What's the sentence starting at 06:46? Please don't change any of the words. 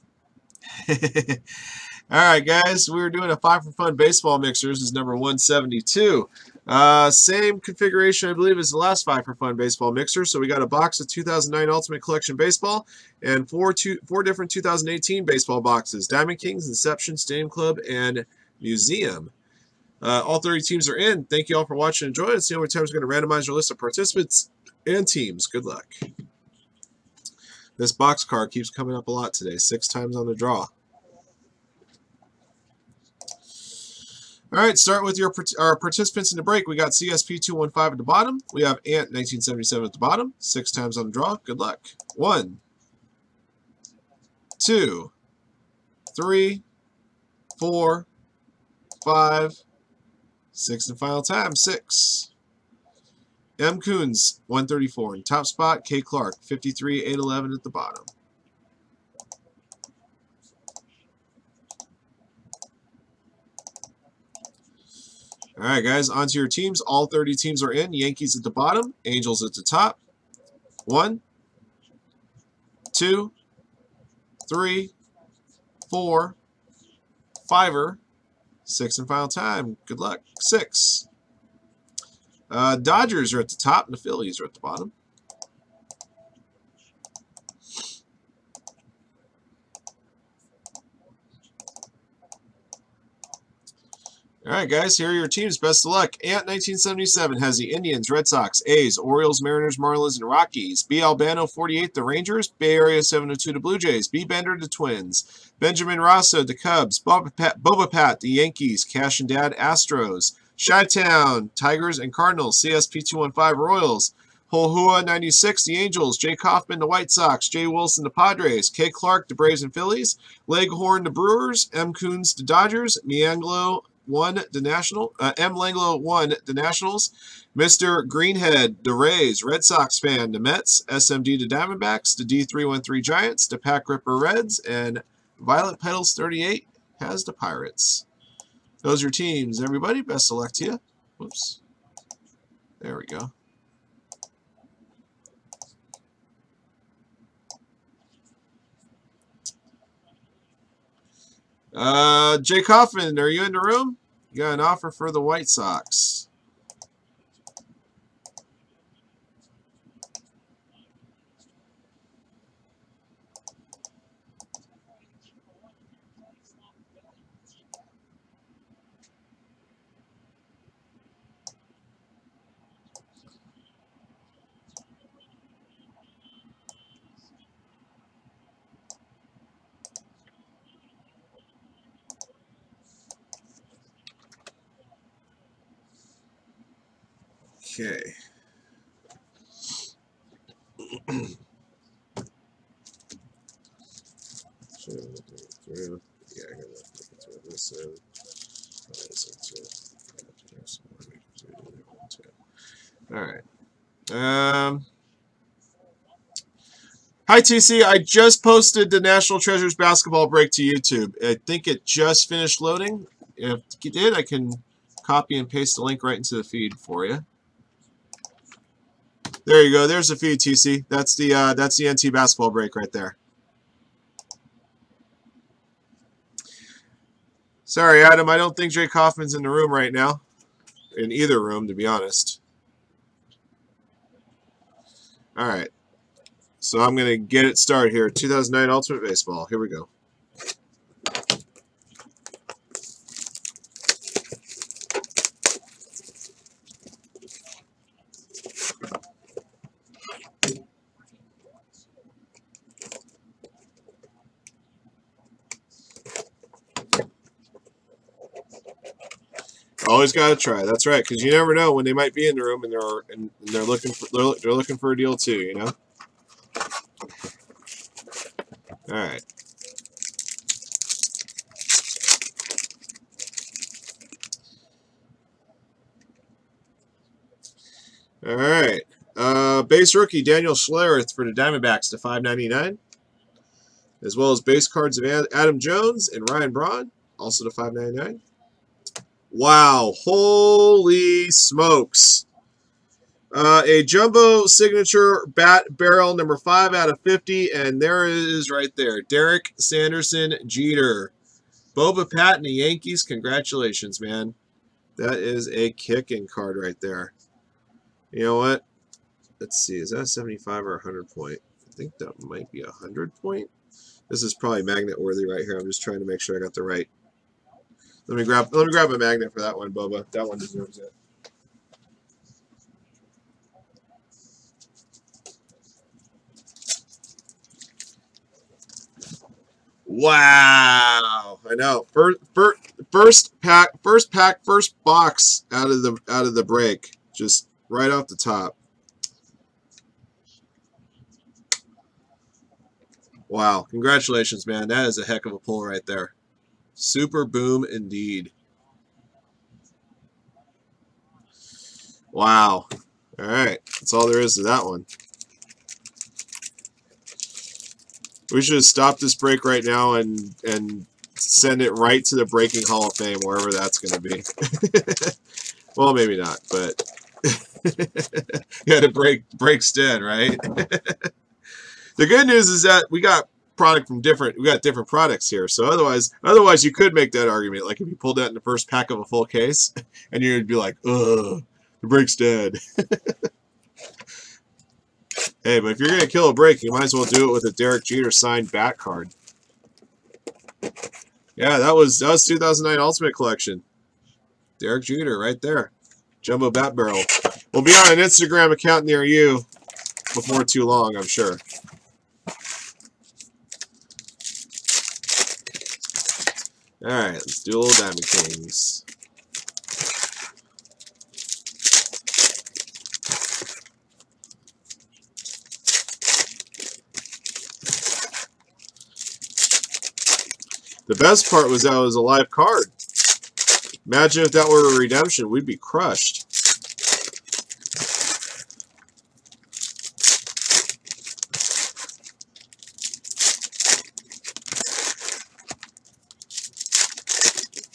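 Alright, let's do a little Diamond Kings.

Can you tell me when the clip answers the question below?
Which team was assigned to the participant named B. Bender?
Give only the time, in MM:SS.
01:44.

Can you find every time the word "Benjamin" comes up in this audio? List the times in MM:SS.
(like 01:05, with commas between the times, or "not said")
01:45.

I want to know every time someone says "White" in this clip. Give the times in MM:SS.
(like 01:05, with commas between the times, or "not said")
01:56, 02:35.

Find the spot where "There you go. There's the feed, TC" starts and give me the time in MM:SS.
03:39.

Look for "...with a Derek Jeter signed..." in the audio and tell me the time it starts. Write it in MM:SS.
06:27.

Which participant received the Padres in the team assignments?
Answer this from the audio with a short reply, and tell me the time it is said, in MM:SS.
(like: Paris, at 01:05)
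Jay Wilson, at 01:57.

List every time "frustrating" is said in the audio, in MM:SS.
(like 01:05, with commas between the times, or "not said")
not said.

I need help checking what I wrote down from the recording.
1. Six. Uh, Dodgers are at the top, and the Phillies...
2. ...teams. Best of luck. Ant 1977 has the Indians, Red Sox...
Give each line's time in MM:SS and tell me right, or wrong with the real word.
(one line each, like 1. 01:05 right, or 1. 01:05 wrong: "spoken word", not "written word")
1. 01:20 right
2. 01:35 right.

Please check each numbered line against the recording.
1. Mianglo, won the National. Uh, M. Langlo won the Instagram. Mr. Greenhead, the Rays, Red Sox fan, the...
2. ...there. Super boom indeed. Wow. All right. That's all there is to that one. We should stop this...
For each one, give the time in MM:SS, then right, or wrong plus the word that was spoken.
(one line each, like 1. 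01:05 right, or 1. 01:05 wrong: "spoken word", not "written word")
1. 02:03 wrong: "Nationals", not "Instagram"
2. 05:45 right.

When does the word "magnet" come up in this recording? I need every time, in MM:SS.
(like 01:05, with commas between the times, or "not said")
05:14, 05:18.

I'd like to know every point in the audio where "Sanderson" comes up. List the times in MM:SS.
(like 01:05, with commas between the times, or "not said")
04:59.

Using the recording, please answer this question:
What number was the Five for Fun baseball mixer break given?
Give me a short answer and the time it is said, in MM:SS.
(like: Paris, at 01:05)
172, at 00:05.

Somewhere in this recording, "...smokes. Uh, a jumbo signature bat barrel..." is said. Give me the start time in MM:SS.
04:51.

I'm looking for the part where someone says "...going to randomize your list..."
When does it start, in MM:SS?
00:23.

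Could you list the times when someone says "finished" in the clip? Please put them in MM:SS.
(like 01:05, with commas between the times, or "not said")
03:32.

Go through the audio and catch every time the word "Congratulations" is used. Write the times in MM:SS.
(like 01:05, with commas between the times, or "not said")
05:03, 05:43.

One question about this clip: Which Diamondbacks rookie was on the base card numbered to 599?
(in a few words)
Daniel Schlereth.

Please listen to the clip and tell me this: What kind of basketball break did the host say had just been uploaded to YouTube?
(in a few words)
National Treasures.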